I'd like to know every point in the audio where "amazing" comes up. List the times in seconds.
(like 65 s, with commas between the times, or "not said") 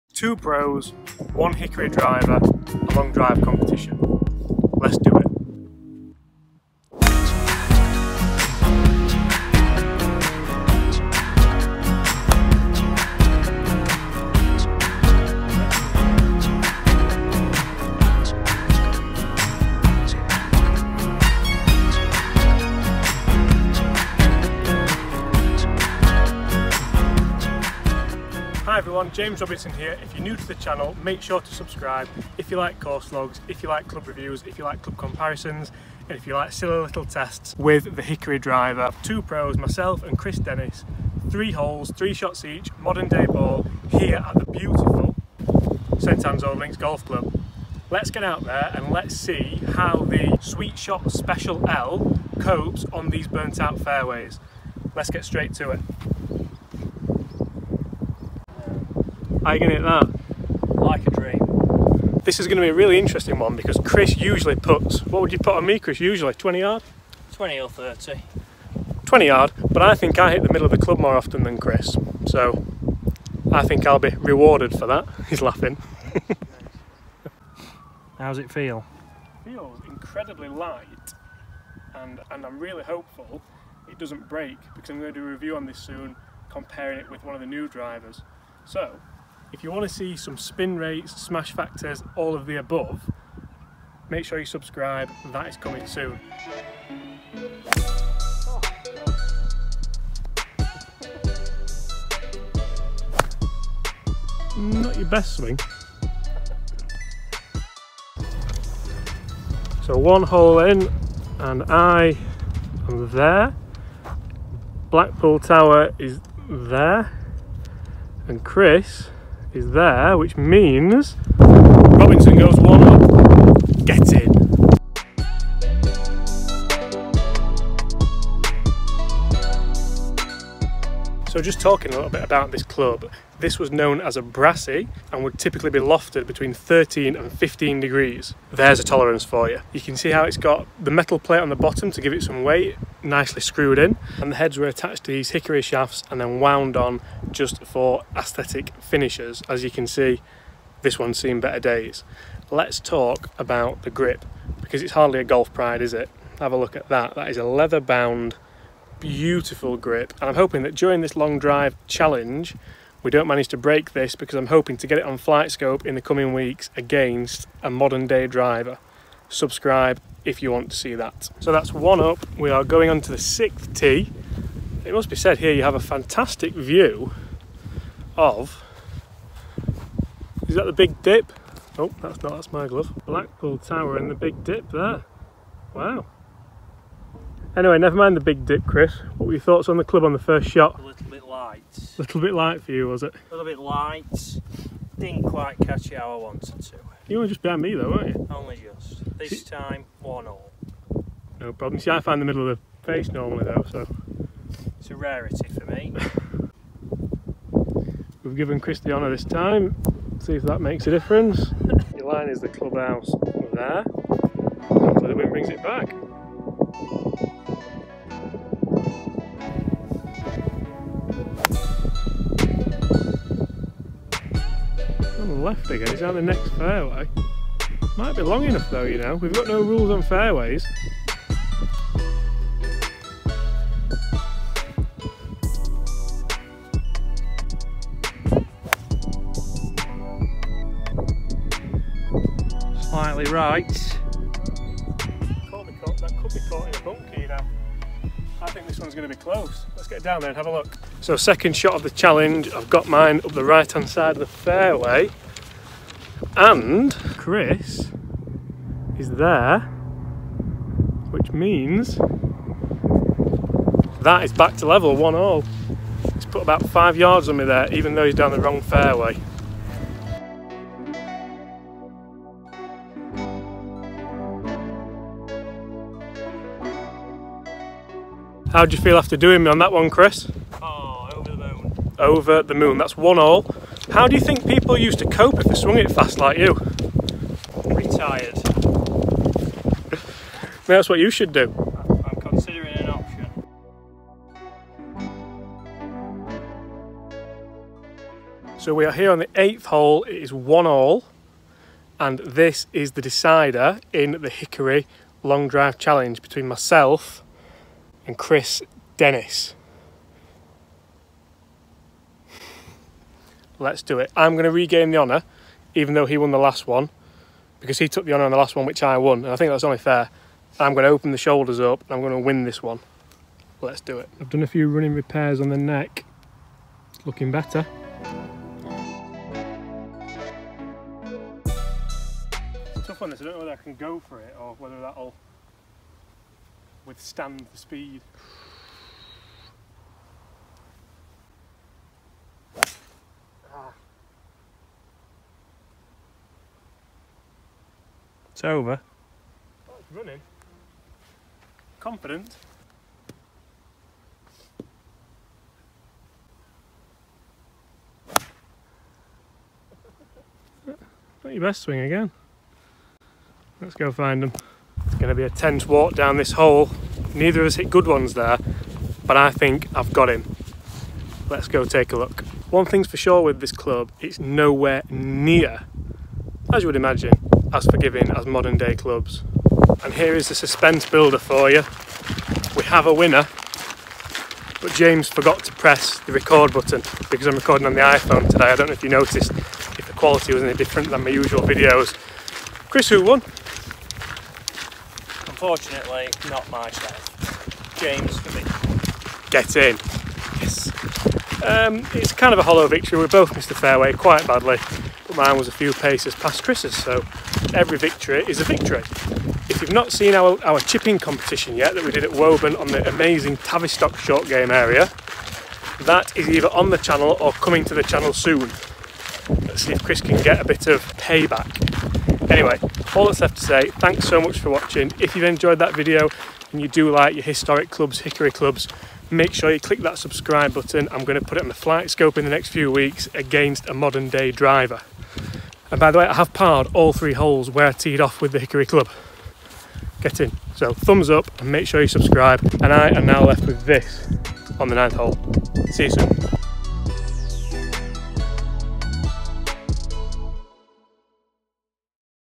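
412 s.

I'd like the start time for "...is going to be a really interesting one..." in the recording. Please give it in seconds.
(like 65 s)
62 s.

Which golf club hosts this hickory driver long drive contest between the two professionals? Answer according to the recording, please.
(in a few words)
St Annes Old Links Golf Club.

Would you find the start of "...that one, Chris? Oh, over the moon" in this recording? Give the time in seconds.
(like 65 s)
279 s.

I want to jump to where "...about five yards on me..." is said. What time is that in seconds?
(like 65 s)
266 s.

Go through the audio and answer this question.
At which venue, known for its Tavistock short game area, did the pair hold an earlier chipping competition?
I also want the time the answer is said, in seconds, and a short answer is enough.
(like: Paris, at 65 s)
Woburn, at 412 s.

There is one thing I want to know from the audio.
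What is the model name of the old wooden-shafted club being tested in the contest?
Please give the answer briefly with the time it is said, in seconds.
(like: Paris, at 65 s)
Sweet Shot Special L, at 50 s.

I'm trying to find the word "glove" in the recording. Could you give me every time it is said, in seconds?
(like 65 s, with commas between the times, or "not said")
182 s.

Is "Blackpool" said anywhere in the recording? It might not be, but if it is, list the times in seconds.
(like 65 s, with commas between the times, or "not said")
114 s, 183 s.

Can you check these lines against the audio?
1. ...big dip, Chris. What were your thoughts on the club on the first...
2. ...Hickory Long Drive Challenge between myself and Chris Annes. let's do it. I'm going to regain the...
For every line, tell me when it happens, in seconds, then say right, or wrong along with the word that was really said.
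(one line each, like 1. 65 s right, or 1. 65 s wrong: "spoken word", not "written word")
1. 188 s right
2. 304 s wrong: "Dennis", not "Annes".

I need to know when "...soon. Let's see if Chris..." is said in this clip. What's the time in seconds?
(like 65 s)
418 s.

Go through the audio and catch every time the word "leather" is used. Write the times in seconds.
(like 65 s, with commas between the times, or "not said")
157 s.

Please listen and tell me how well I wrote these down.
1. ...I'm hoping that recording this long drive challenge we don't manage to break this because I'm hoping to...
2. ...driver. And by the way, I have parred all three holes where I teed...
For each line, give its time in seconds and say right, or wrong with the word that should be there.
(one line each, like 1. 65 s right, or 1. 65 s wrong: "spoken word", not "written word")
1. 160 s wrong: "during", not "recording"
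2. 434 s right.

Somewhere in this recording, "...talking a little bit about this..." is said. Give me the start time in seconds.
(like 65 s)
131 s.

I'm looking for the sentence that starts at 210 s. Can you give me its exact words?
See if that makes a difference.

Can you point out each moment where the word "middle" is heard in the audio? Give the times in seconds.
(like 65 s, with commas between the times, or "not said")
70 s, 202 s.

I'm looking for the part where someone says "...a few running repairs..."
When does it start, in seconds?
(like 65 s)
324 s.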